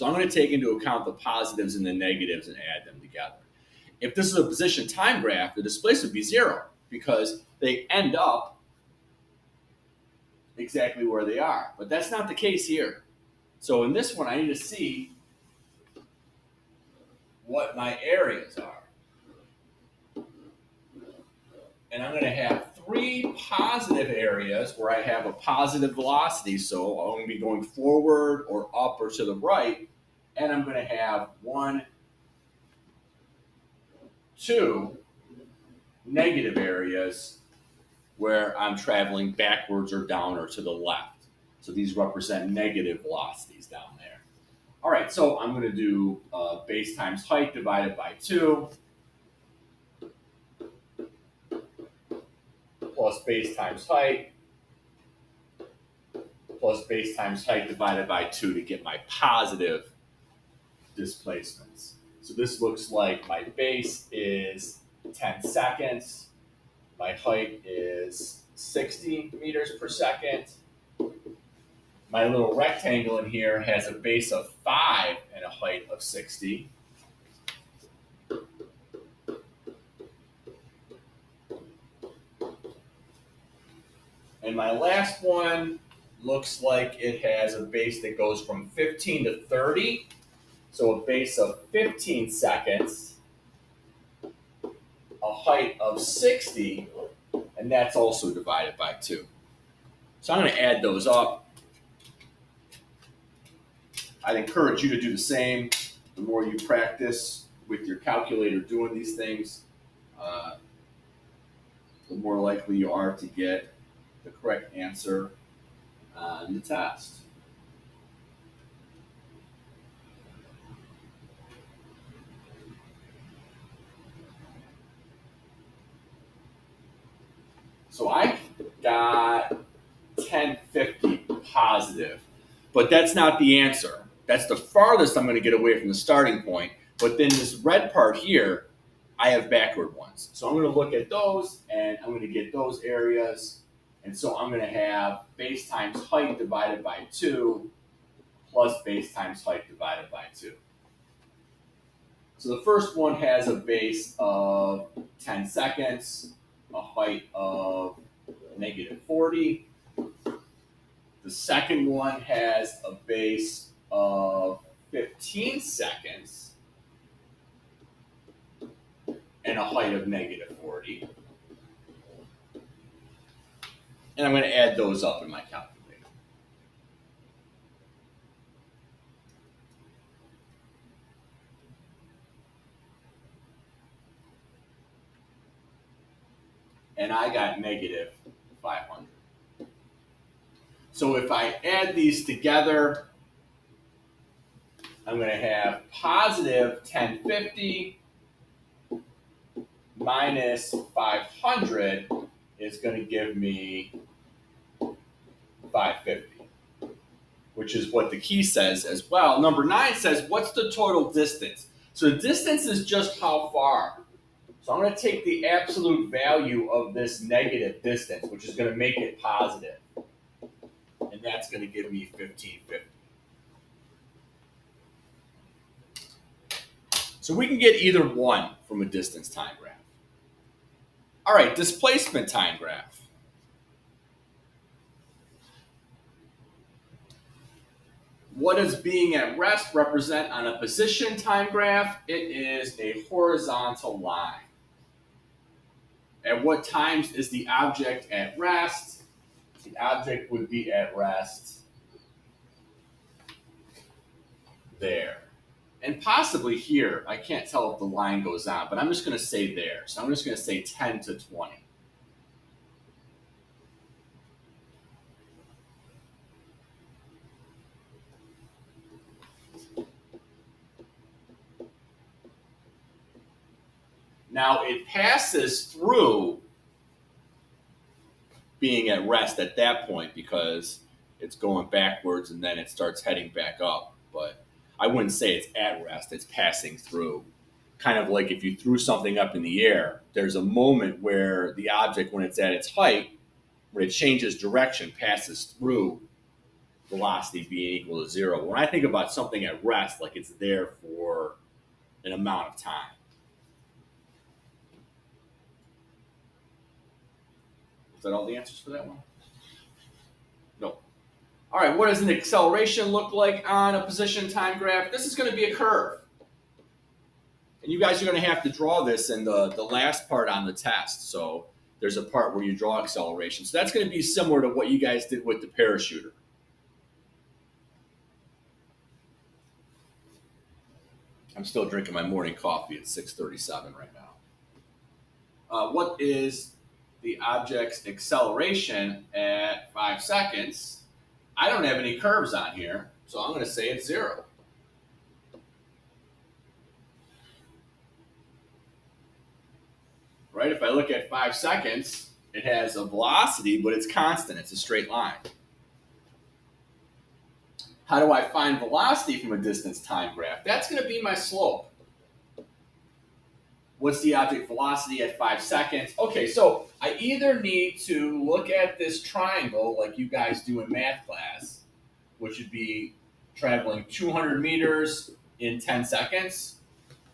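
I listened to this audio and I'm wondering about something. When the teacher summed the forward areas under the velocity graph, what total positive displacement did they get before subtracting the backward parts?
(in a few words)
1050.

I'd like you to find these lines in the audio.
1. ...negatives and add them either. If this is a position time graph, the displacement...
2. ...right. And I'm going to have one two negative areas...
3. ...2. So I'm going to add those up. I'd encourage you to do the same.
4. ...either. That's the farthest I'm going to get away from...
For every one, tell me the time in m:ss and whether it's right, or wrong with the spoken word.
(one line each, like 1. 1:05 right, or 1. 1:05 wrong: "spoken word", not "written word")
1. 0:01 wrong: "together", not "either"
2. 0:29 right
3. 1:38 right
4. 2:13 wrong: "answer", not "either".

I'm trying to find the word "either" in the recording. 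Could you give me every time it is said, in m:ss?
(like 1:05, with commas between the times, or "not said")
3:47, 6:06.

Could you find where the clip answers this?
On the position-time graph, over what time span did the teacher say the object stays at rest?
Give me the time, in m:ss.
4:20.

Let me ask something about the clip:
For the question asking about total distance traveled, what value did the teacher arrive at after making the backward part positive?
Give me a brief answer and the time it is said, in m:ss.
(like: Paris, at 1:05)
1550, at 3:42.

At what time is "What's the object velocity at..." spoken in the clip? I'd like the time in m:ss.
6:03.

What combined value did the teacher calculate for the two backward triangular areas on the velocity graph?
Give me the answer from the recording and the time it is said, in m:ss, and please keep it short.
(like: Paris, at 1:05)
-500, at 3:07.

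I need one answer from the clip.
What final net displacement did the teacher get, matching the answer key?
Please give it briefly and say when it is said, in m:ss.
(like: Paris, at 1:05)
550, at 3:24.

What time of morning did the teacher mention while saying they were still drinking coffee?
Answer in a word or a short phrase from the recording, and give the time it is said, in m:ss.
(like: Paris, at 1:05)
6:37, at 5:32.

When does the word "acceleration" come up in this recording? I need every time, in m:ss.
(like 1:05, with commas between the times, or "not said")
5:12, 5:22, 5:37.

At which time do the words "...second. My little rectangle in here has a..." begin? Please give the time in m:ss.
1:09.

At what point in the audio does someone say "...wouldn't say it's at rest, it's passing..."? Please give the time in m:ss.
4:44.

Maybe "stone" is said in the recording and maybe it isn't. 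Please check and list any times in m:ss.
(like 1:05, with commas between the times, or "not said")
not said.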